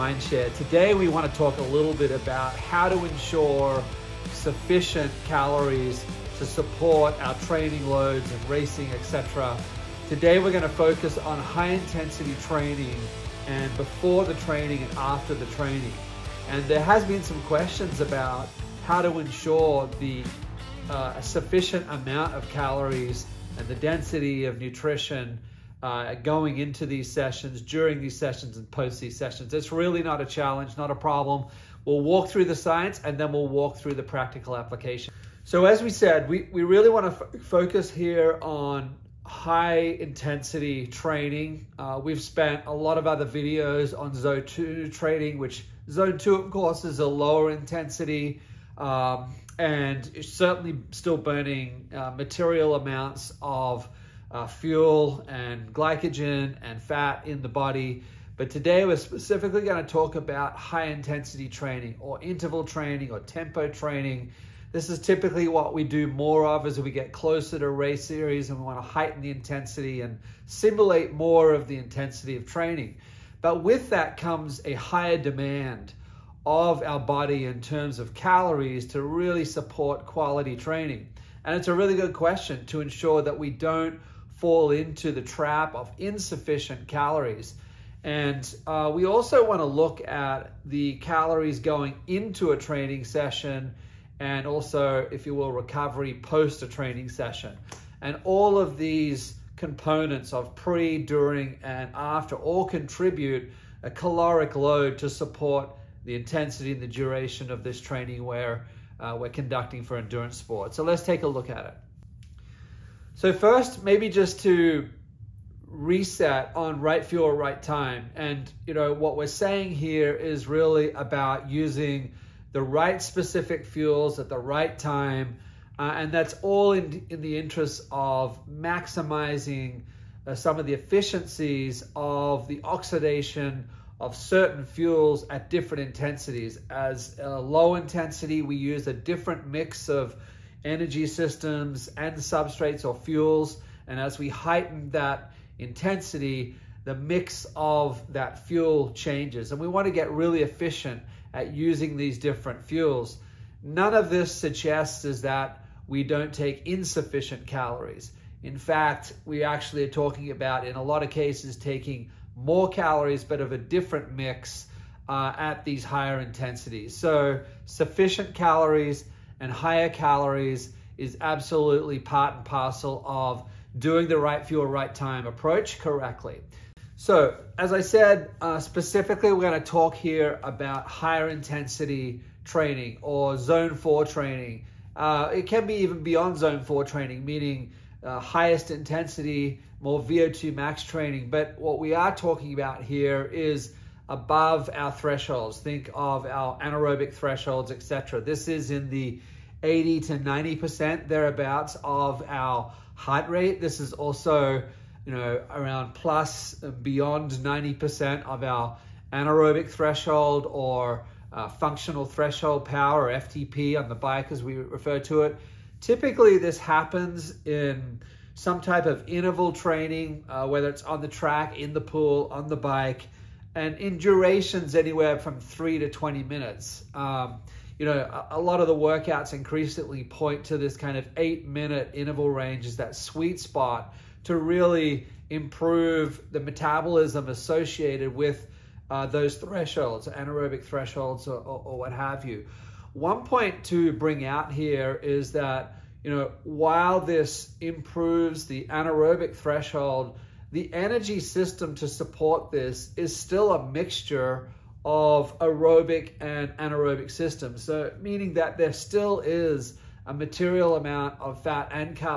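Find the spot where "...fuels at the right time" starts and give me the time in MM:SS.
02:03.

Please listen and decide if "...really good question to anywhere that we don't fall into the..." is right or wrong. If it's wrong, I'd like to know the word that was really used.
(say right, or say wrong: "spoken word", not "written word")
wrong: "ensure", not "anywhere".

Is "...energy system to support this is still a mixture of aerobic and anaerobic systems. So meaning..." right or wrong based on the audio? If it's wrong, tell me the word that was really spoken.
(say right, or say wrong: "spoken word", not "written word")
right.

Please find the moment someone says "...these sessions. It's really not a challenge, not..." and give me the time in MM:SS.
00:28.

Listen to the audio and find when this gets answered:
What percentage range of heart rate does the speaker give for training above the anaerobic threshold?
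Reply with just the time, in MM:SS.
03:19.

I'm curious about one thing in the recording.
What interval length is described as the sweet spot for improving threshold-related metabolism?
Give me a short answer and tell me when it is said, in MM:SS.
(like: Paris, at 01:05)
8 minutes, at 03:51.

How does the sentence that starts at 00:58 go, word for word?
But today we're specifically going to talk about high intensity training or interval training or tempo training.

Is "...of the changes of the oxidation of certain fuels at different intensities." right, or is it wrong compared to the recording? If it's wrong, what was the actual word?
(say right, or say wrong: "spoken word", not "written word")
wrong: "efficiencies", not "changes".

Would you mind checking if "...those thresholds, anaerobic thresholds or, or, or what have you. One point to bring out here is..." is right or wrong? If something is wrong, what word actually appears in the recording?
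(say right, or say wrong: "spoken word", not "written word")
right.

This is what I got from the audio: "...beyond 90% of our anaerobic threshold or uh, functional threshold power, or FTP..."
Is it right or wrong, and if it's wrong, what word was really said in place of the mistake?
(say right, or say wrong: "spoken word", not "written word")
right.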